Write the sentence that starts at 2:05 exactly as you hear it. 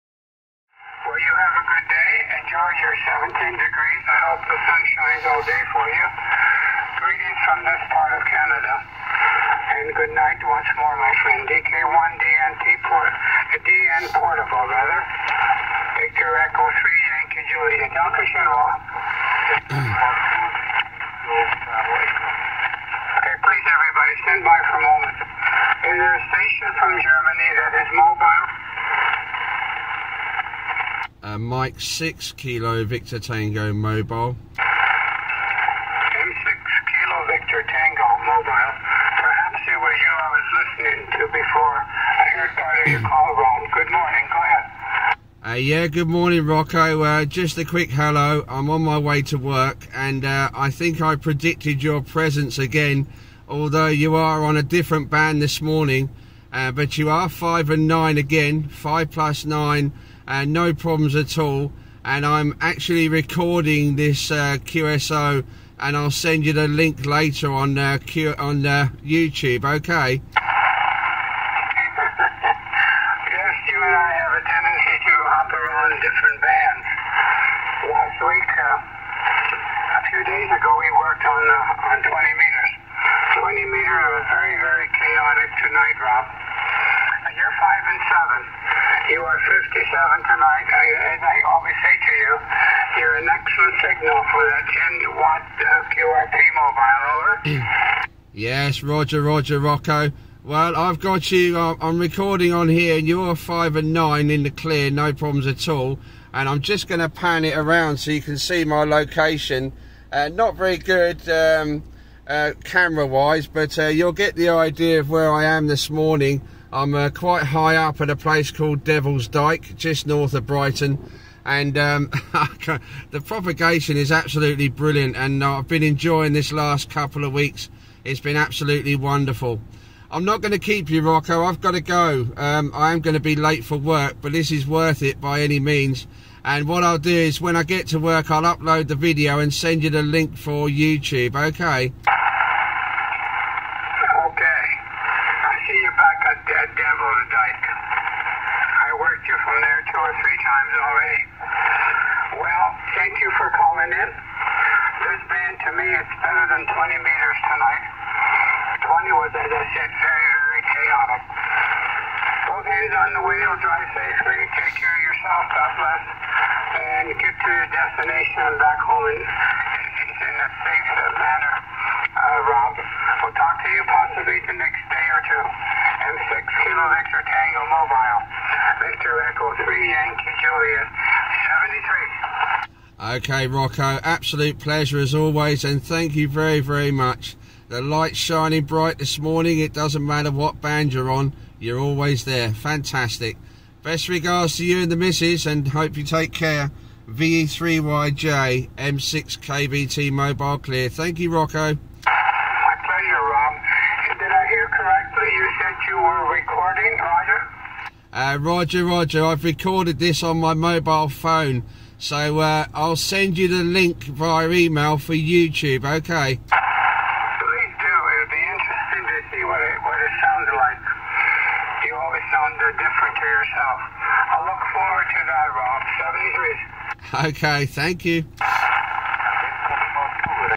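And uh, I've been enjoying this last couple of weeks.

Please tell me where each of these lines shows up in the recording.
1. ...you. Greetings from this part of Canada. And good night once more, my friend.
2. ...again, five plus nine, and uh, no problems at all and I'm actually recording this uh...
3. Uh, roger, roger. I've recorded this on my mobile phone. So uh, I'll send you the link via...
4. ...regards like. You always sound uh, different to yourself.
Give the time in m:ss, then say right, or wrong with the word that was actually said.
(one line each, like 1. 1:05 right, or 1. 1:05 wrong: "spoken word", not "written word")
1. 0:05 right
2. 0:58 right
3. 3:28 right
4. 3:40 wrong: "sounds", not "regards".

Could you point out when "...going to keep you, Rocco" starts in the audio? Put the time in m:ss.
2:10.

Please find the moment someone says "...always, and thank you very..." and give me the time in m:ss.
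3:05.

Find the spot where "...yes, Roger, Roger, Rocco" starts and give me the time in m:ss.
1:38.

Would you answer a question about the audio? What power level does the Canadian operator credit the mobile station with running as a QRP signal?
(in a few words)
10 watts.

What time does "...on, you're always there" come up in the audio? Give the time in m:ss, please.
3:11.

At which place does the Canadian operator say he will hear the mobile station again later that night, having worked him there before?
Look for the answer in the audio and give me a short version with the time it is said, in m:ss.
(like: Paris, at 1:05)
Danville, at 2:26.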